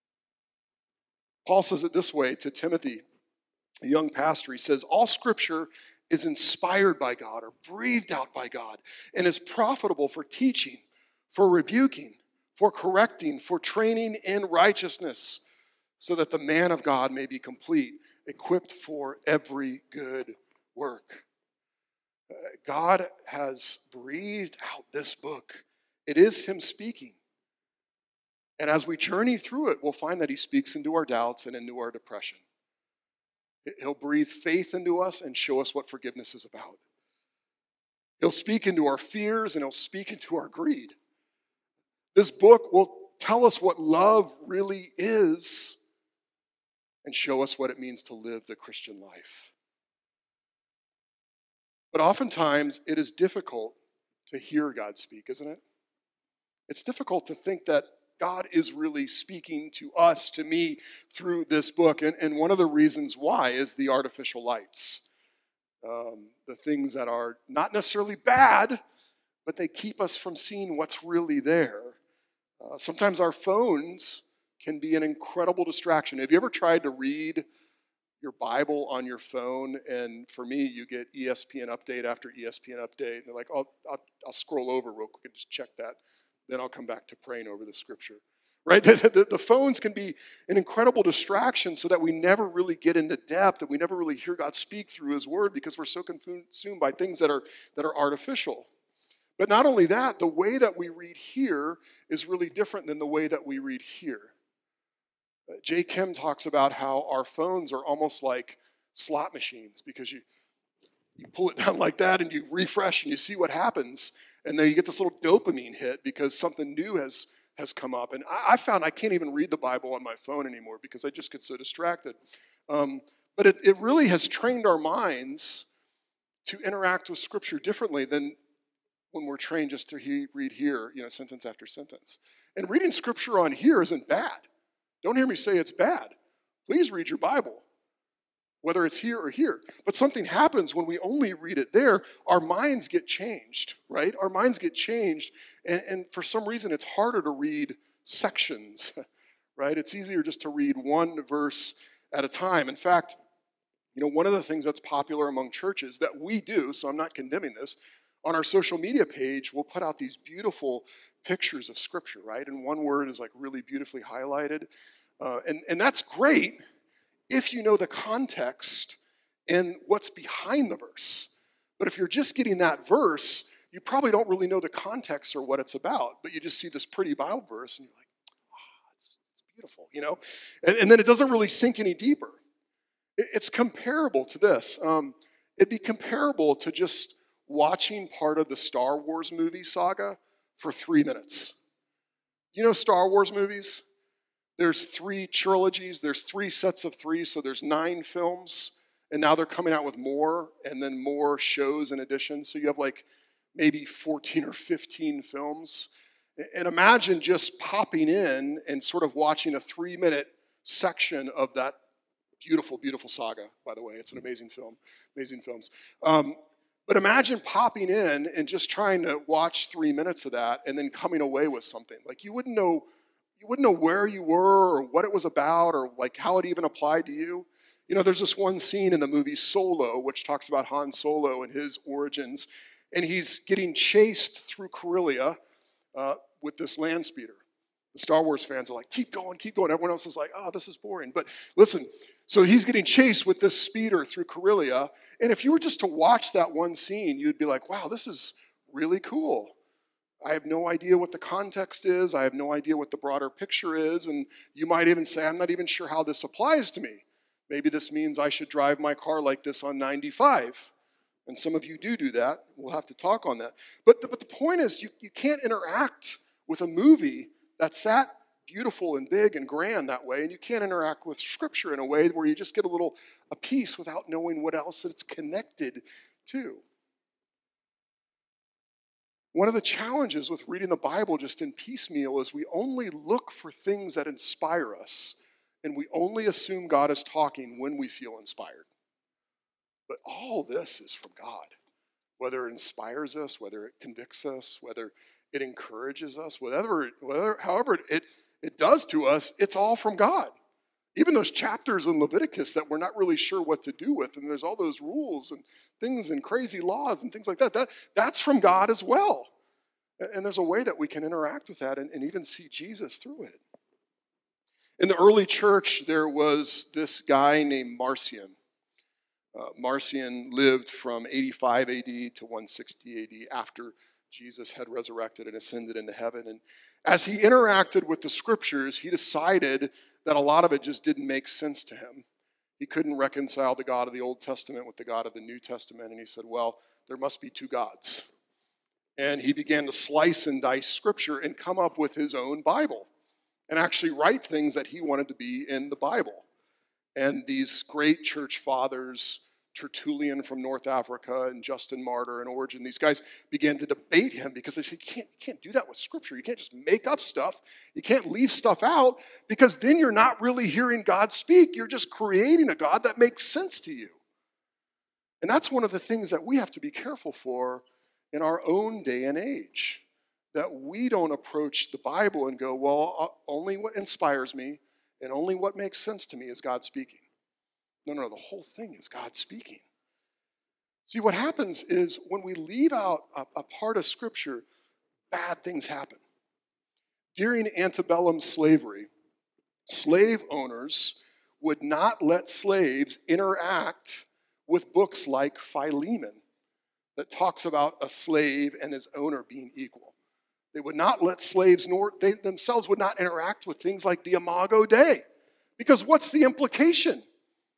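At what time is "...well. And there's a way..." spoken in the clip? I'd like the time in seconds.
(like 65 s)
308 s.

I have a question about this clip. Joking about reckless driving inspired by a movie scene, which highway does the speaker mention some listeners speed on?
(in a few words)
95.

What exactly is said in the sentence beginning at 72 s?
Uh, sometimes our phones can be an incredible distraction.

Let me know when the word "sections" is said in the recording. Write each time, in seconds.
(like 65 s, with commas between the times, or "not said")
148 s, 210 s.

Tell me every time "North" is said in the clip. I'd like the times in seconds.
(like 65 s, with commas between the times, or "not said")
350 s.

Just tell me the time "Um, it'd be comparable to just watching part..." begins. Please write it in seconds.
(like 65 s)
184 s.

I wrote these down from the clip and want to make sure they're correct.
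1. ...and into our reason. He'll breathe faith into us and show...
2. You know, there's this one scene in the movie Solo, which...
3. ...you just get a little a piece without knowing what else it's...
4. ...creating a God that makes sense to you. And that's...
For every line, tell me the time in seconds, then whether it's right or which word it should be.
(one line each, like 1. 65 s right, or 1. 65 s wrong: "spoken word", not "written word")
1. 31 s wrong: "depression", not "reason"
2. 227 s right
3. 272 s right
4. 361 s right.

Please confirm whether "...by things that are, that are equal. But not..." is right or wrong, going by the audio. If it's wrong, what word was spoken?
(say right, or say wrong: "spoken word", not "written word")
wrong: "artificial", not "equal".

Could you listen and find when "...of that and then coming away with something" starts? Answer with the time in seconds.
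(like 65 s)
220 s.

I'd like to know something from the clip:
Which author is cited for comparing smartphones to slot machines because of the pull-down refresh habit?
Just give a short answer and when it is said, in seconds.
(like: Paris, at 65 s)
Jay Kim, at 105 s.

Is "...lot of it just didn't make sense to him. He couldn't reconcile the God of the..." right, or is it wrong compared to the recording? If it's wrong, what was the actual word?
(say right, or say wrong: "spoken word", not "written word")
right.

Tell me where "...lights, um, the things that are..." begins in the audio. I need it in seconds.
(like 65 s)
64 s.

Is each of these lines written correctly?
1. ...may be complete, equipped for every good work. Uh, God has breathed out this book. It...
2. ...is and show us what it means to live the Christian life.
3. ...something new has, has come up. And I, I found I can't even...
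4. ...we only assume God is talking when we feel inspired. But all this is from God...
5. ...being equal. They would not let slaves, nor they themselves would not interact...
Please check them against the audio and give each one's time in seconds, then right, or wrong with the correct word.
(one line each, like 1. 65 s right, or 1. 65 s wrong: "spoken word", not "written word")
1. 17 s right
2. 44 s right
3. 116 s right
4. 285 s right
5. 399 s right.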